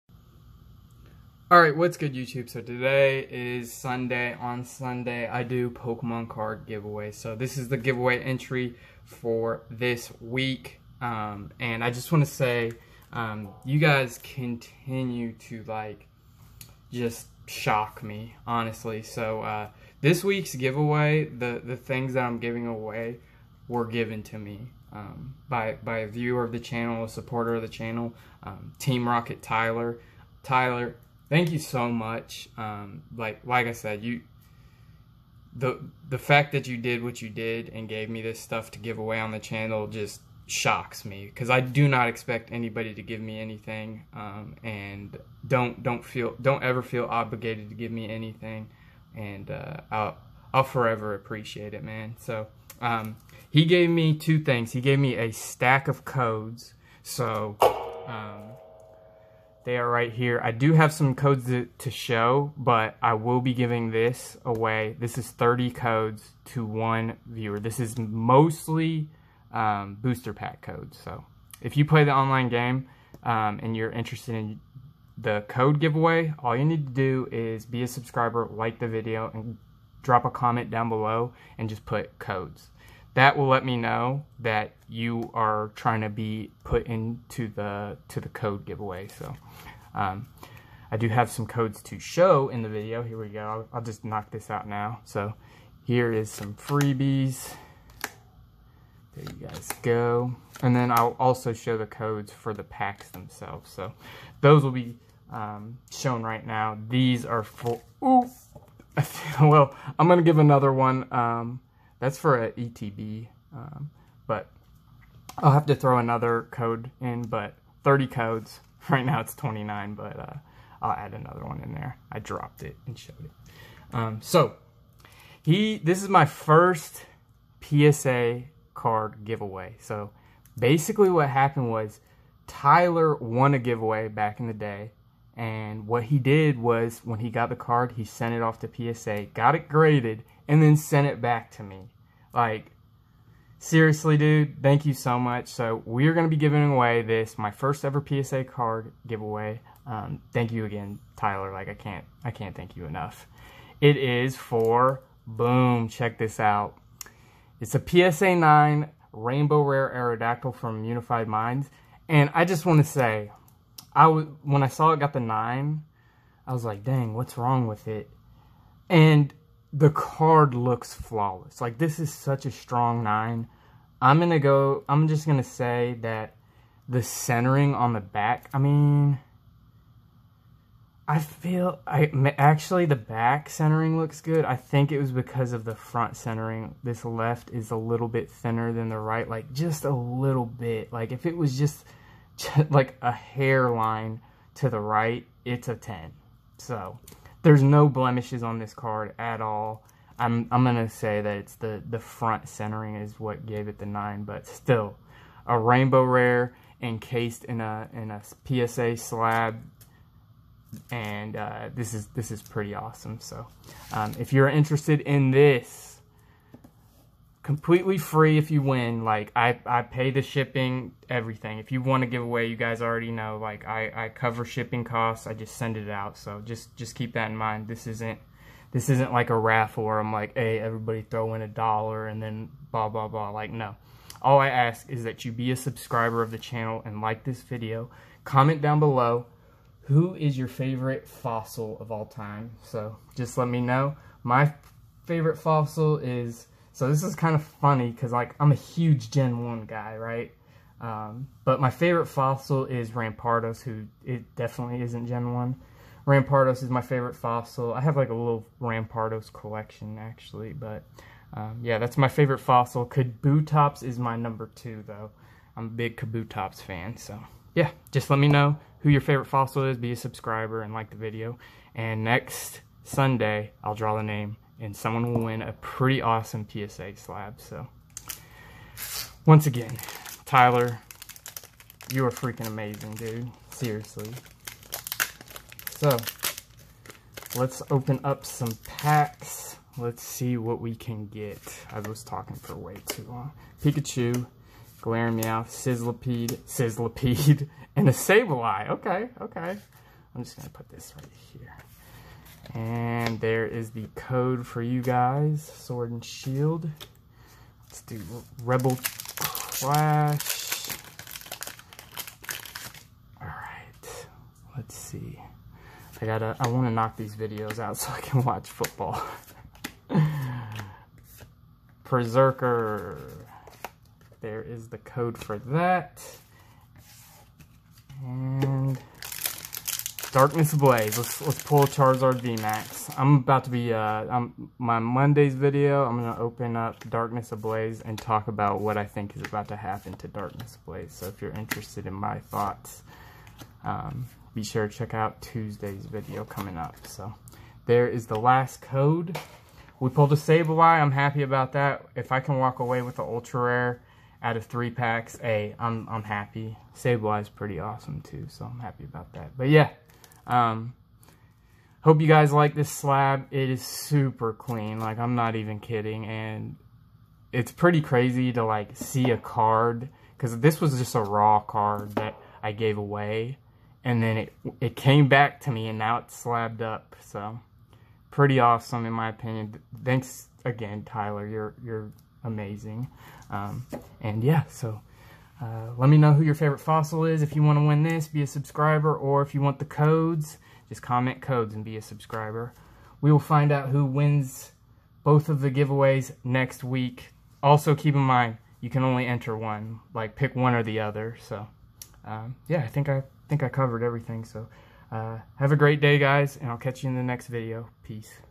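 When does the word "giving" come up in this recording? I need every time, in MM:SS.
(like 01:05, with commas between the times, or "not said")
00:22, 01:03, 02:26.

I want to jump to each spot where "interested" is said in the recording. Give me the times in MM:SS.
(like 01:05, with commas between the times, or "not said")
01:13, 03:34, 05:41.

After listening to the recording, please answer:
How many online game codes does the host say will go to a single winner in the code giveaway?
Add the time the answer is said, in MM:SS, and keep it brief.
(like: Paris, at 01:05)
30, at 01:05.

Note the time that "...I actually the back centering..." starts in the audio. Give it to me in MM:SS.
03:01.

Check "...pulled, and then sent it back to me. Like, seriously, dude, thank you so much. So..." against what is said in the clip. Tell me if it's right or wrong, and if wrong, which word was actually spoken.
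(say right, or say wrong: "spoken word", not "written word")
wrong: "graded", not "pulled".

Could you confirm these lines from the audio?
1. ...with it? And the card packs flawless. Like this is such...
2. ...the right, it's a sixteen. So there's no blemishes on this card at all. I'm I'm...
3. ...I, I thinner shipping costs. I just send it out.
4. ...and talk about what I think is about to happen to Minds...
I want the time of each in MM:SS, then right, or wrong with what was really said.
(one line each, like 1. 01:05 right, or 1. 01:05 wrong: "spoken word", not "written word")
1. 02:47 wrong: "looks", not "packs"
2. 03:14 wrong: "ten", not "sixteen"
3. 03:43 wrong: "cover", not "thinner"
4. 05:37 wrong: "Darkness", not "Minds".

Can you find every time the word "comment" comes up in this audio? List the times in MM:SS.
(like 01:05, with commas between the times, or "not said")
01:20, 03:58, 06:30.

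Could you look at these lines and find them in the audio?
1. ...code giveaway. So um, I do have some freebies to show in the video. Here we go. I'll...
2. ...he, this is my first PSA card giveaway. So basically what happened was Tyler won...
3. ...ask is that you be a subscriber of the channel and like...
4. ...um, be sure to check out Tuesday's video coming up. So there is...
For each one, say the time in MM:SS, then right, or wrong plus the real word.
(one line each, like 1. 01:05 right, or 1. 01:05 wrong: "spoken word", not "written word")
1. 01:28 wrong: "codes", not "freebies"
2. 02:05 right
3. 03:54 right
4. 05:43 right.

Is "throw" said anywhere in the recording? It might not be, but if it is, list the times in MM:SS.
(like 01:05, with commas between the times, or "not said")
01:55, 03:51.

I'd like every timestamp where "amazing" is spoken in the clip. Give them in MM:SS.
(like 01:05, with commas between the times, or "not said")
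04:42, 06:22.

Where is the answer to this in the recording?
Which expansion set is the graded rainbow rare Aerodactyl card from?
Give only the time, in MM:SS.
02:40.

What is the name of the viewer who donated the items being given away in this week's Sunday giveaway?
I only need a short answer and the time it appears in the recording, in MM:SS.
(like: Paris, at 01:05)
Team Rocket Tyler, at 00:28.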